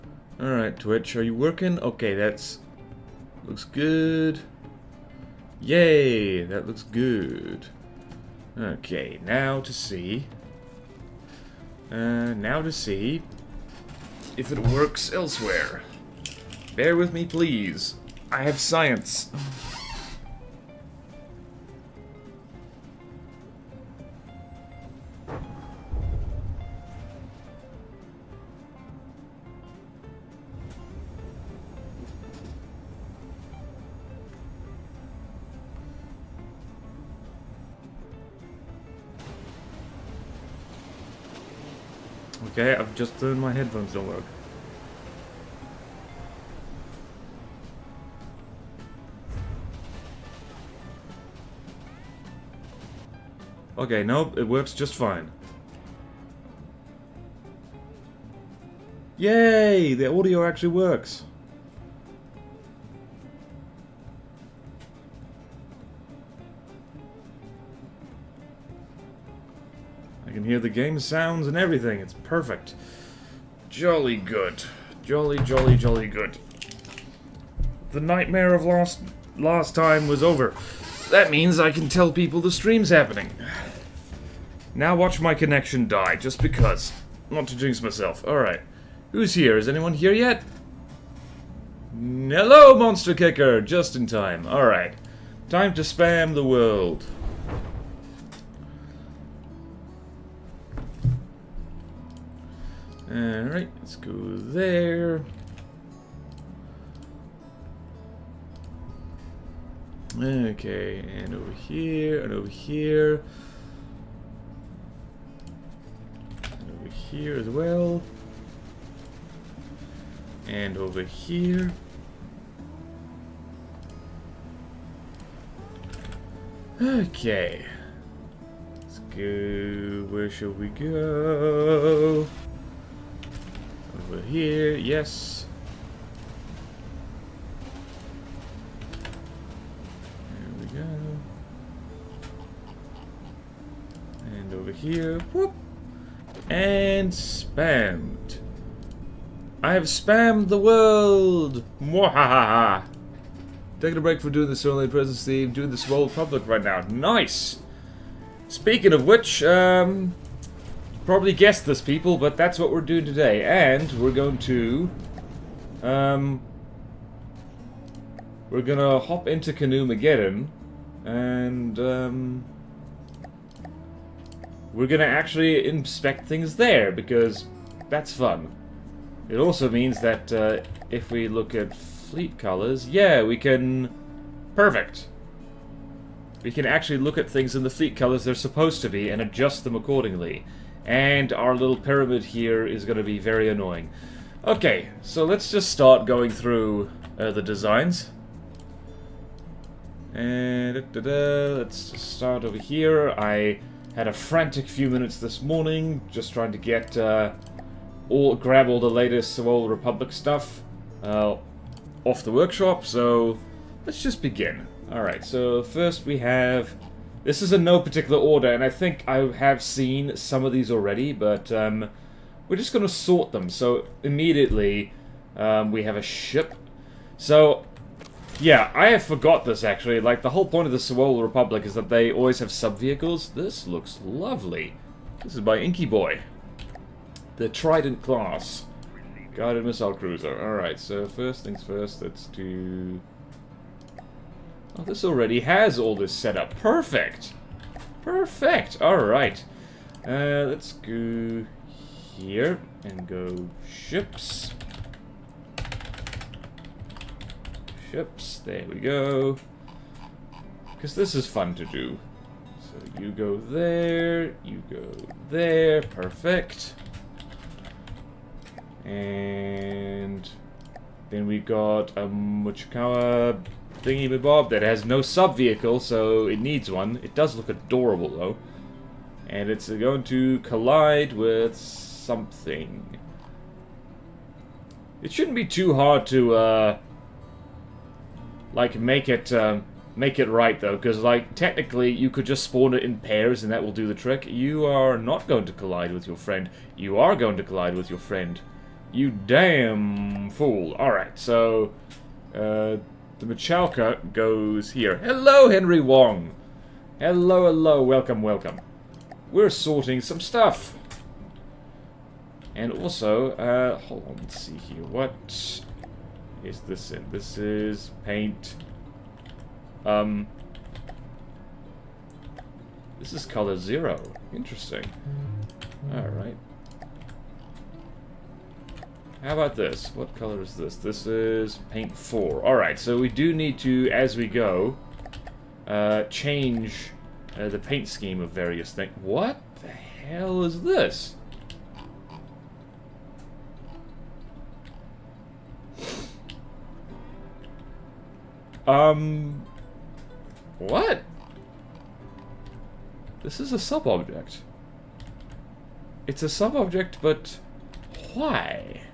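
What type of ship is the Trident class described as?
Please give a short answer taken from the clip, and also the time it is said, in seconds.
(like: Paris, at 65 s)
Guided missile cruiser, at 239 s.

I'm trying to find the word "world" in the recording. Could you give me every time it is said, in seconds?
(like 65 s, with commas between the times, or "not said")
96 s, 150 s.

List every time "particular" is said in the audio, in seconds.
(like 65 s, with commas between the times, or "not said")
217 s.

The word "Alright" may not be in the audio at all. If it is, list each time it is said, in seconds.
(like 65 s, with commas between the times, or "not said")
0 s, 88 s, 94 s, 103 s, 240 s, 300 s, 332 s.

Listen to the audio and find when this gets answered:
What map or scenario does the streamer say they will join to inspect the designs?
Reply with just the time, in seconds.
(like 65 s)
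169 s.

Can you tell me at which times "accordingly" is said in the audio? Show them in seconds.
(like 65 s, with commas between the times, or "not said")
189 s.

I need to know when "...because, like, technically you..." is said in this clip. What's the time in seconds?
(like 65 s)
290 s.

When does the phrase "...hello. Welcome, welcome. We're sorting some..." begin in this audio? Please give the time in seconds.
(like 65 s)
307 s.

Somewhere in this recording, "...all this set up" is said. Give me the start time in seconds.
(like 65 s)
245 s.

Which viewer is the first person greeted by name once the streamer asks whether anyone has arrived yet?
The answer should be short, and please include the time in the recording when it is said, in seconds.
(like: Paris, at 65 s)
Monster Kicker, at 92 s.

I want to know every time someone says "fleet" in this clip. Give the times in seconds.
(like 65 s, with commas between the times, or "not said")
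181 s, 187 s.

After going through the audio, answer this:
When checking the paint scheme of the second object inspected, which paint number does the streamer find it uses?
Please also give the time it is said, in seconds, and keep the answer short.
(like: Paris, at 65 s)
4, at 331 s.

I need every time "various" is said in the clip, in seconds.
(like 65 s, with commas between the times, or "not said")
338 s.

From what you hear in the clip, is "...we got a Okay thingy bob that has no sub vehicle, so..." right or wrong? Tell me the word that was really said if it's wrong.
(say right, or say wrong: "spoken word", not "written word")
wrong: "Muchikawa", not "Okay".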